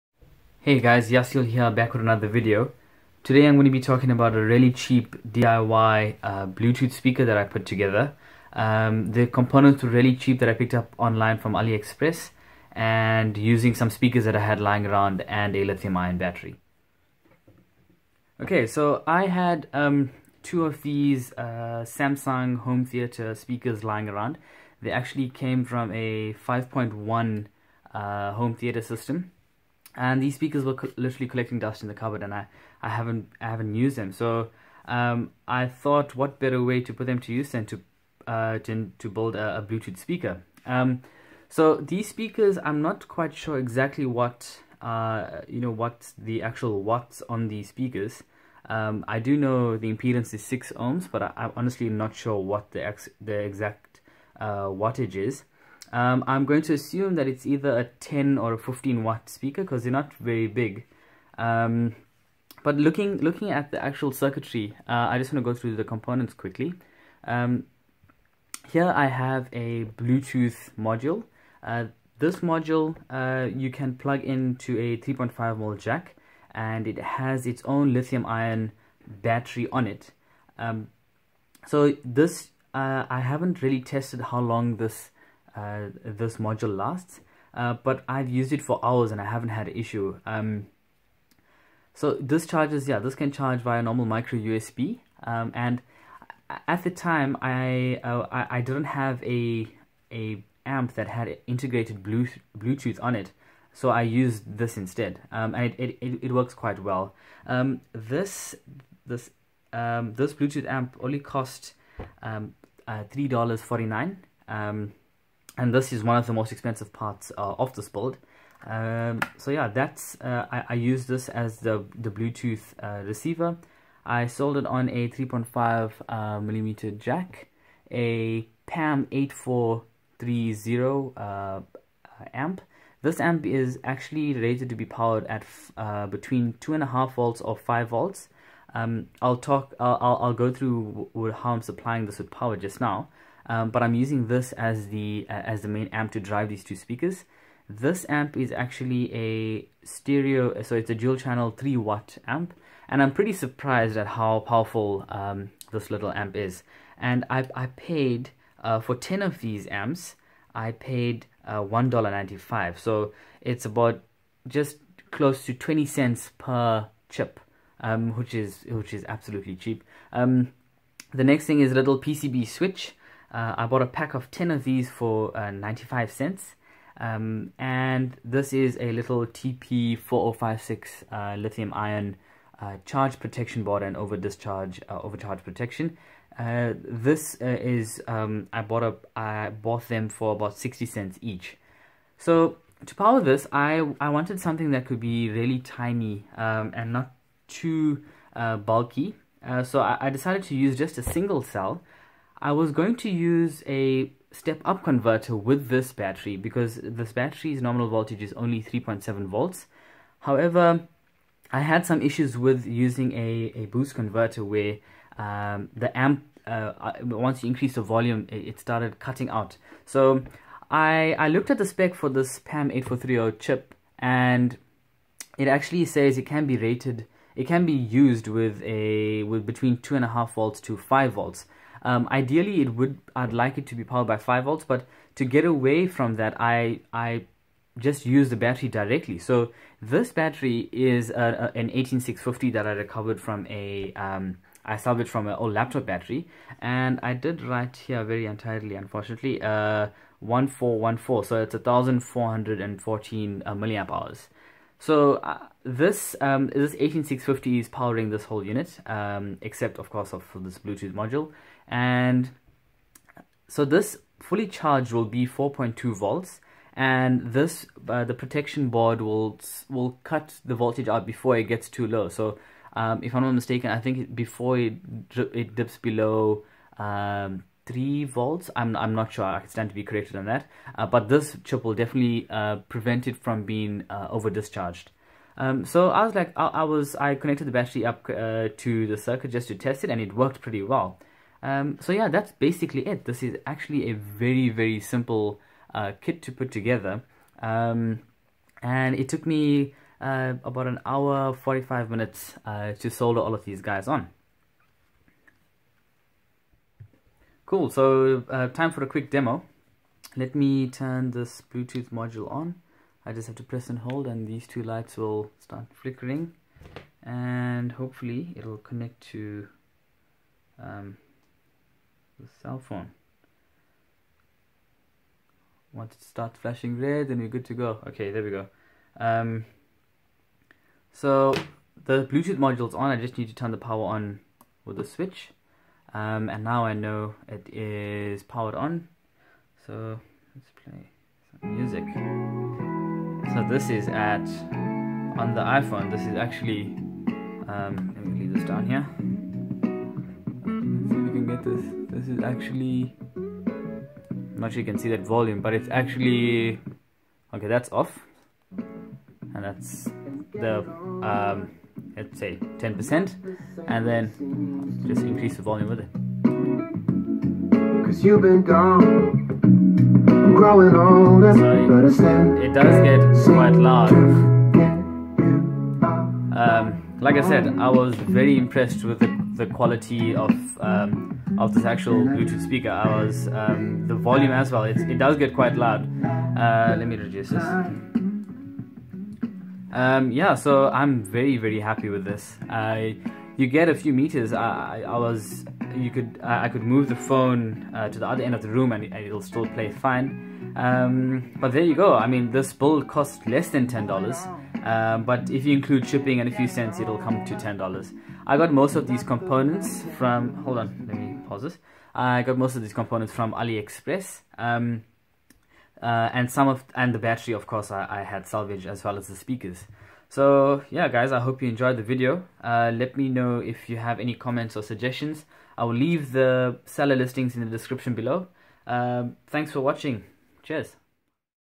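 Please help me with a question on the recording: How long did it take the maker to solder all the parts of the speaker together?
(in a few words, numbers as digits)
about 45 minutes.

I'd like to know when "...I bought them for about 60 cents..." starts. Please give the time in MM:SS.
03:09.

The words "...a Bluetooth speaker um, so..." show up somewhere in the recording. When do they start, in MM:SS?
00:39.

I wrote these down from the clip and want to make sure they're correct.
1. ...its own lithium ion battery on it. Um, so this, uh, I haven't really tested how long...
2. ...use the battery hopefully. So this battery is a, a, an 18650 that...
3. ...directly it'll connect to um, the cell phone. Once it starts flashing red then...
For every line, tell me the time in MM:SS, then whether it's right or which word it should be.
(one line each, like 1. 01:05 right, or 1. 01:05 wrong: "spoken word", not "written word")
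1. 01:17 right
2. 03:58 wrong: "directly", not "hopefully"
3. 05:17 wrong: "hopefully", not "directly".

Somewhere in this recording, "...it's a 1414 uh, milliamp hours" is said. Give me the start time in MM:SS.
04:11.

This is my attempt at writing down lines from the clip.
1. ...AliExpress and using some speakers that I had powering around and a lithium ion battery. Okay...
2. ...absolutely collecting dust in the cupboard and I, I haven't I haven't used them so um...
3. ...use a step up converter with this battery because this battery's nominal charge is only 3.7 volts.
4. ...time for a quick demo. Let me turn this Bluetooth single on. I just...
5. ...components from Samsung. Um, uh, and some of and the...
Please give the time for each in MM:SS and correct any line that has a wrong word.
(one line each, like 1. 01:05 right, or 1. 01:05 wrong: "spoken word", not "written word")
1. 00:11 wrong: "lying", not "powering"
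2. 00:30 wrong: "literally", not "absolutely"
3. 03:23 wrong: "voltage", not "charge"
4. 05:08 wrong: "module", not "single"
5. 06:52 wrong: "AliExpress", not "Samsung".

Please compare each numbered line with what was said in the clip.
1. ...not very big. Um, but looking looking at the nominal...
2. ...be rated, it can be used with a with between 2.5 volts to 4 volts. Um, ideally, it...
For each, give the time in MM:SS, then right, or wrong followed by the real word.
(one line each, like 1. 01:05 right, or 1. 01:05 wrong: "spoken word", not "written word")
1. 00:59 wrong: "actual", not "nominal"
2. 03:46 wrong: "5", not "4".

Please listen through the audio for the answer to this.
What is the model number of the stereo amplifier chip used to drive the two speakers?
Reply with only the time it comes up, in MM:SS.
02:08.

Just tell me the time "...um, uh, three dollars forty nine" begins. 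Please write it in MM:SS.
01:52.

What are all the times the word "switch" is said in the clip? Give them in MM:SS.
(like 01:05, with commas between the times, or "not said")
02:52, 05:34.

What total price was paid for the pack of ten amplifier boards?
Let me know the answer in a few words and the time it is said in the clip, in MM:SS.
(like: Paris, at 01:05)
$1.95, at 02:41.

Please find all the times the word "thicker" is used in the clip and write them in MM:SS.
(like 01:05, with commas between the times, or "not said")
not said.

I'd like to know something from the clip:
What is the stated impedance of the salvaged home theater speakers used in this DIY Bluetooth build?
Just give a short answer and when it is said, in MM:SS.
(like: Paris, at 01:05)
6 ohms, at 00:50.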